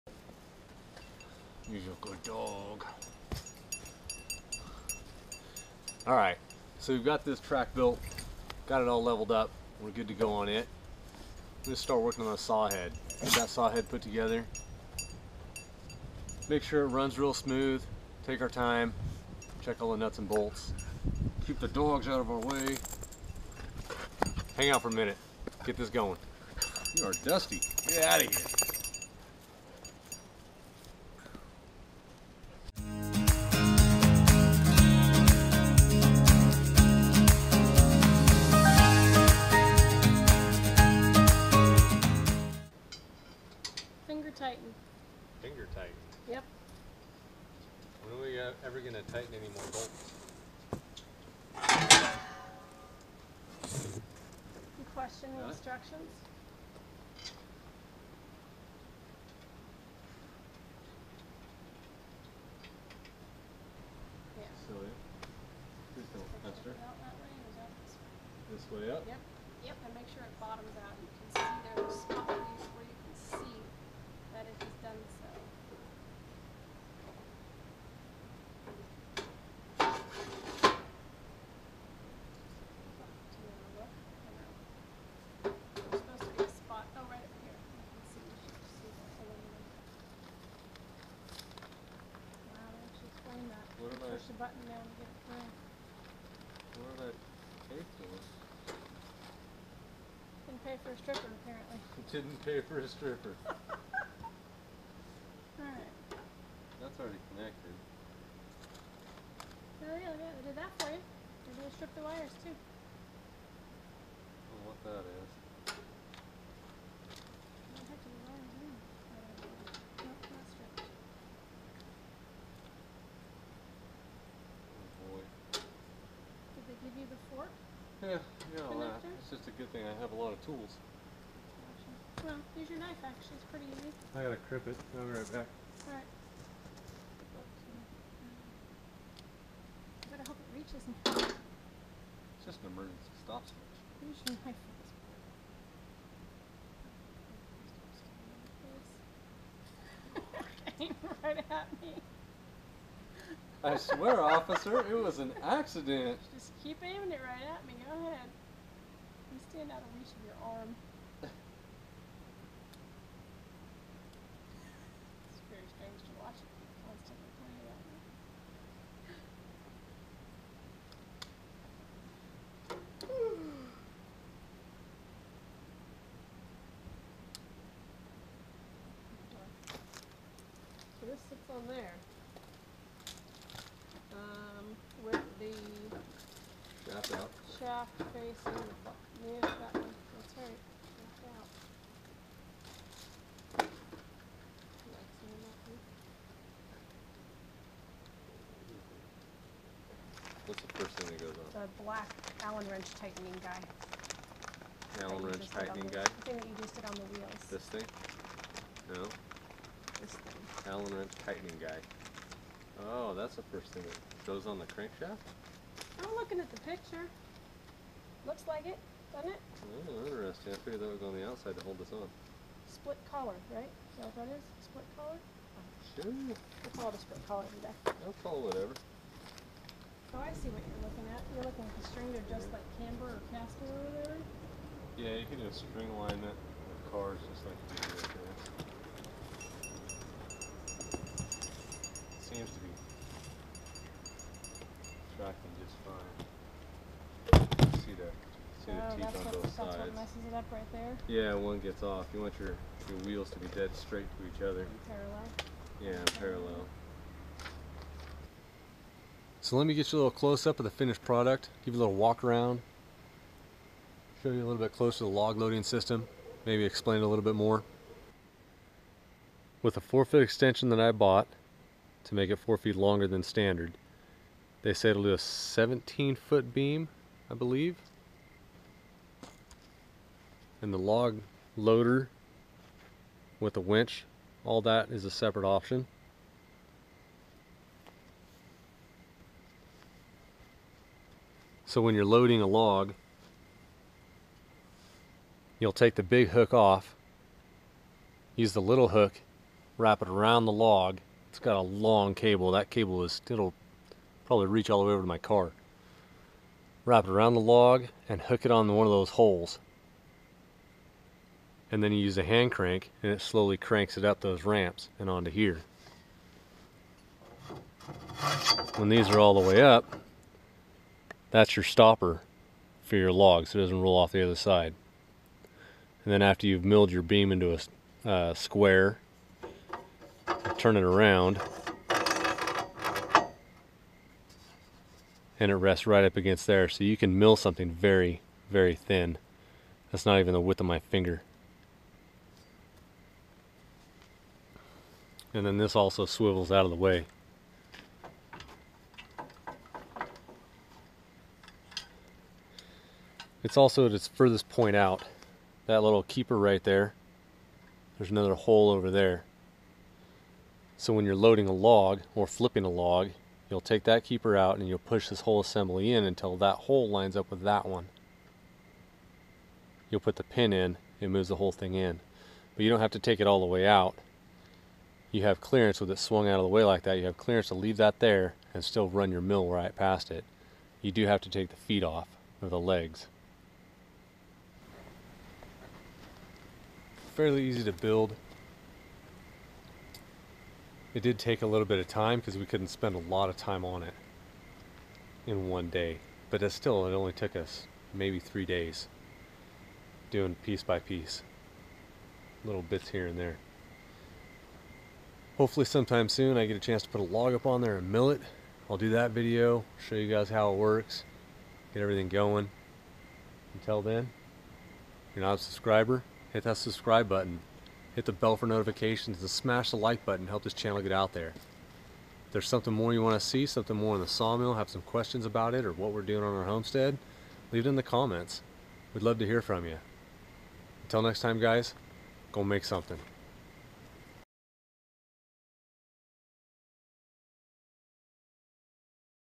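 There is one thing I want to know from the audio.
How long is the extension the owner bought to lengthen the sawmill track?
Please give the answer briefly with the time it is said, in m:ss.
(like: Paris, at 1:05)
4 feet, at 4:29.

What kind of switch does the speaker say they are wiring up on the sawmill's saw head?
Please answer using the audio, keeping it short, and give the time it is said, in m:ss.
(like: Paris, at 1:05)
Emergency stop switch, at 2:22.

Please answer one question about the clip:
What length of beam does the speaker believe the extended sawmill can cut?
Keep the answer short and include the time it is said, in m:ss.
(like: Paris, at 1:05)
17 feet, at 4:35.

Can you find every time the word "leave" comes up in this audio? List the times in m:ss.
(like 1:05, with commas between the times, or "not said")
6:17, 7:07.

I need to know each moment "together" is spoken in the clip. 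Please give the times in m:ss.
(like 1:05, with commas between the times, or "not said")
0:14.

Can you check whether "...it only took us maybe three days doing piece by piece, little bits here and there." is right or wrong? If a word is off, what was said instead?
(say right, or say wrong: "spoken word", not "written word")
right.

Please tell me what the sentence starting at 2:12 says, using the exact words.
Well, use your knife actually, it's pretty easy.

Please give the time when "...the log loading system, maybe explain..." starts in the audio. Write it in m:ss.
4:25.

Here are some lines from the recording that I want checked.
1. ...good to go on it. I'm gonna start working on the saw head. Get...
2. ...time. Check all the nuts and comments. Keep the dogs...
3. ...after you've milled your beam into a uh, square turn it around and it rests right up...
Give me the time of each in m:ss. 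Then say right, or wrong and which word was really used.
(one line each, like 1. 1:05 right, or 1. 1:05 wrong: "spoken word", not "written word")
1. 0:09 right
2. 0:18 wrong: "bolts", not "comments"
3. 5:26 right.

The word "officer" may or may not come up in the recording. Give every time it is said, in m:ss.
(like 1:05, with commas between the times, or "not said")
2:34.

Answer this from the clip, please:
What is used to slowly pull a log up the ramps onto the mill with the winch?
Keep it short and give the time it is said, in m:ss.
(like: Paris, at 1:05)
Hand crank, at 5:12.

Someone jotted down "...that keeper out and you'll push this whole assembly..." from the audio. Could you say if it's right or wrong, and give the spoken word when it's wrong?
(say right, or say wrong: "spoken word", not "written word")
right.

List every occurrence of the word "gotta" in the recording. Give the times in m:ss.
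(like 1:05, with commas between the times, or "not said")
2:14.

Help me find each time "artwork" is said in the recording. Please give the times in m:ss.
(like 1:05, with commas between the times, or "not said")
not said.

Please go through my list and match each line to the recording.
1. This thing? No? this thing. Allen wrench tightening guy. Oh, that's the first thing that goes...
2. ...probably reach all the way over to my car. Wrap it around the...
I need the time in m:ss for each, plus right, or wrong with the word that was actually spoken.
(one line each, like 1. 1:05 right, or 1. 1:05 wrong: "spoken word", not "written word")
1. 3:27 right
2. 5:04 right.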